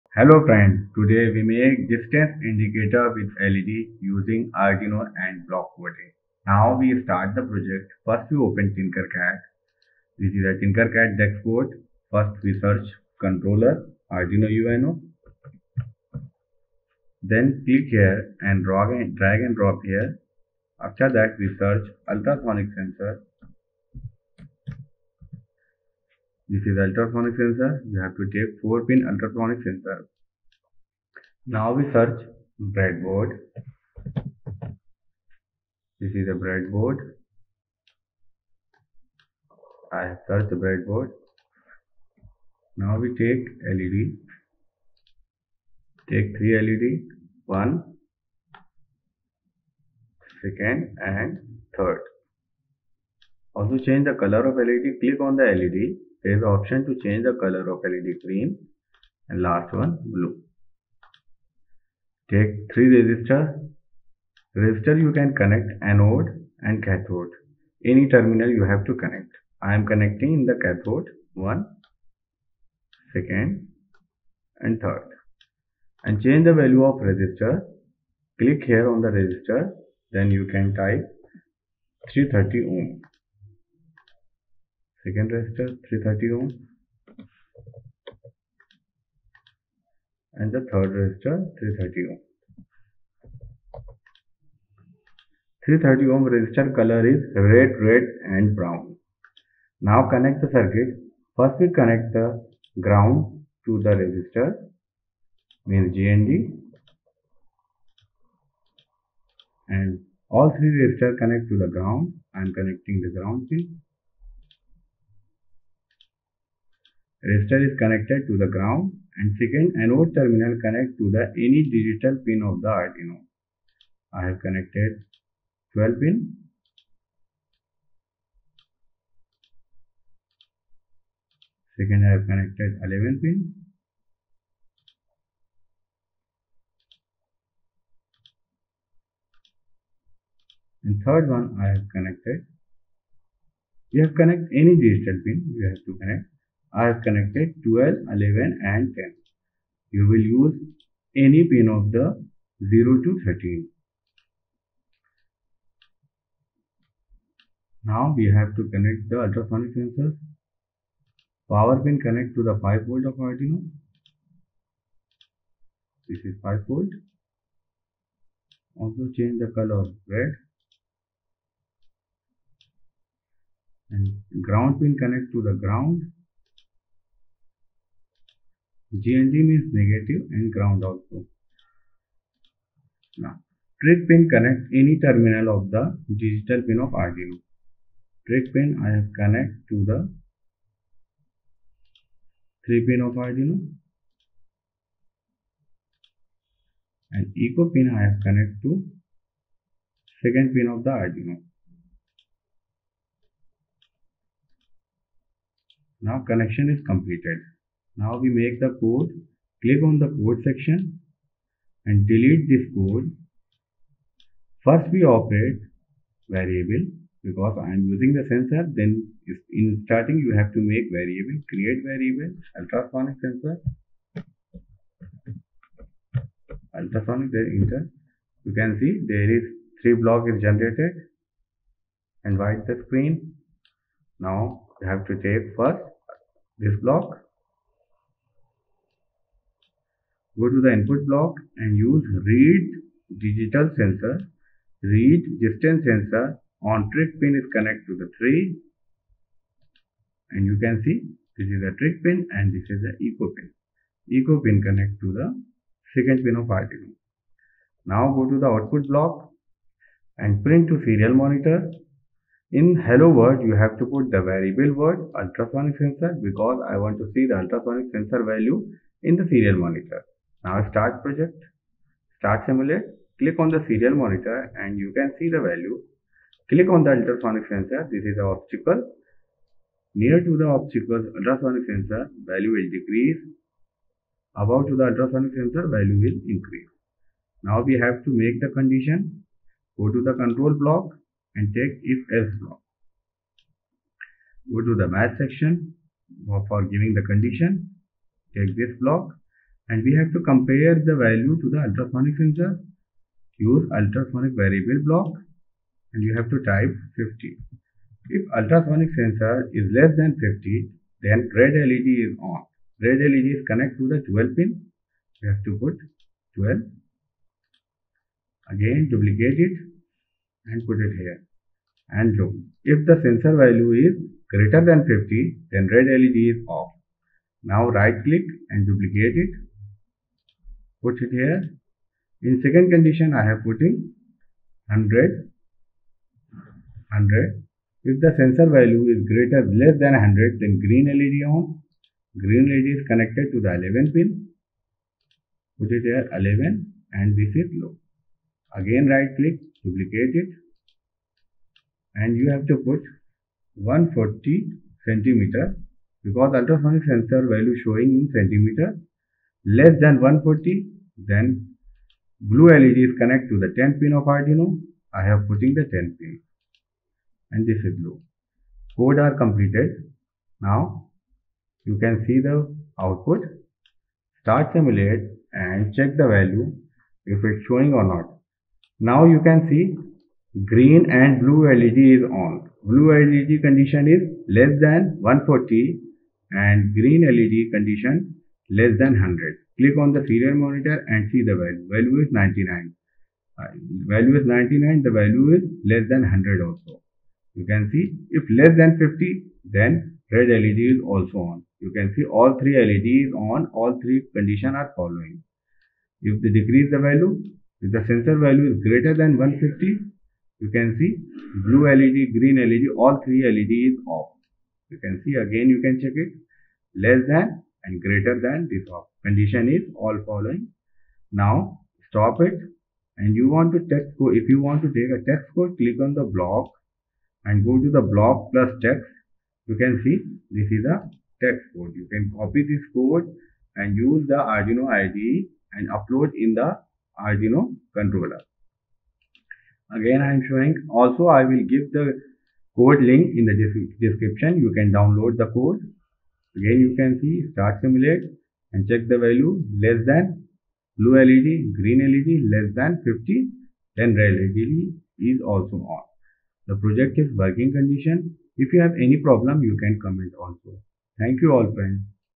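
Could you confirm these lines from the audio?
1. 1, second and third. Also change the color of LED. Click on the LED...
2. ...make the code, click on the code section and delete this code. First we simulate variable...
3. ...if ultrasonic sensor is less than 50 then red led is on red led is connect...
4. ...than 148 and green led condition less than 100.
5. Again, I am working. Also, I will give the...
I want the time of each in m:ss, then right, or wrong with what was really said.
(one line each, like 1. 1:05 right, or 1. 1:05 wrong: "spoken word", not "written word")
1. 0:47 right
2. 3:28 wrong: "operate", not "simulate"
3. 5:08 right
4. 6:24 wrong: "140", not "148"
5. 7:19 wrong: "showing", not "working".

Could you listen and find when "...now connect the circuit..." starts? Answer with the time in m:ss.
1:39.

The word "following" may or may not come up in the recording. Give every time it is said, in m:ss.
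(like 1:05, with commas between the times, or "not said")
6:44, 7:00.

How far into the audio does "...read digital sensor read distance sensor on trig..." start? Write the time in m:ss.
4:02.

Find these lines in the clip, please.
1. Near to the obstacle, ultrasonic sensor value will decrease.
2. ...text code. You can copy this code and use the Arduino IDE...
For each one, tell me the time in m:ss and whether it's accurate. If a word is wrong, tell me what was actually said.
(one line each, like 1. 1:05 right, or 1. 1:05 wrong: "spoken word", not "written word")
1. 4:39 right
2. 7:11 right.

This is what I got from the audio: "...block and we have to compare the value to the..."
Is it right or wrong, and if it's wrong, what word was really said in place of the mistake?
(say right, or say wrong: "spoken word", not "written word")
right.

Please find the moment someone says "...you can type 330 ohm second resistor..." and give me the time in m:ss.
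1:20.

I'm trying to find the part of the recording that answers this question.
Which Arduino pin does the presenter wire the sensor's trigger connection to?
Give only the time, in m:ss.
3:12.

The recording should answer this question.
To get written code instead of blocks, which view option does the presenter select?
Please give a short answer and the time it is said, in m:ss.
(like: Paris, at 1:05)
block plus text, at 7:07.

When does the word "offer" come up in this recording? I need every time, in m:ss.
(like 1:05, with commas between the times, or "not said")
not said.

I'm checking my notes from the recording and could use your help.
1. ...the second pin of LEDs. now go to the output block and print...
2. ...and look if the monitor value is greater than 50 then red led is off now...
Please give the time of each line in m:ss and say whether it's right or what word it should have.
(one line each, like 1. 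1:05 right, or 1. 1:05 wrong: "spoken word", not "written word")
1. 4:15 wrong: "Arduino", not "LEDs"
2. 5:21 wrong: "sensor", not "monitor".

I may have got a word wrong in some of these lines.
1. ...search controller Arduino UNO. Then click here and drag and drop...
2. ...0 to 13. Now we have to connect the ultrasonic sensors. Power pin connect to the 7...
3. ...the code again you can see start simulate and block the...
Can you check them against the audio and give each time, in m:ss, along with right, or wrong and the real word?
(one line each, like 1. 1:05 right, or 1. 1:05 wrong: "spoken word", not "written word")
1. 0:12 right
2. 2:32 wrong: "5", not "7"
3. 7:25 wrong: "check", not "block".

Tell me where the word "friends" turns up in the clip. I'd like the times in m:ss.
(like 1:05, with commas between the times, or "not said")
0:00, 7:41.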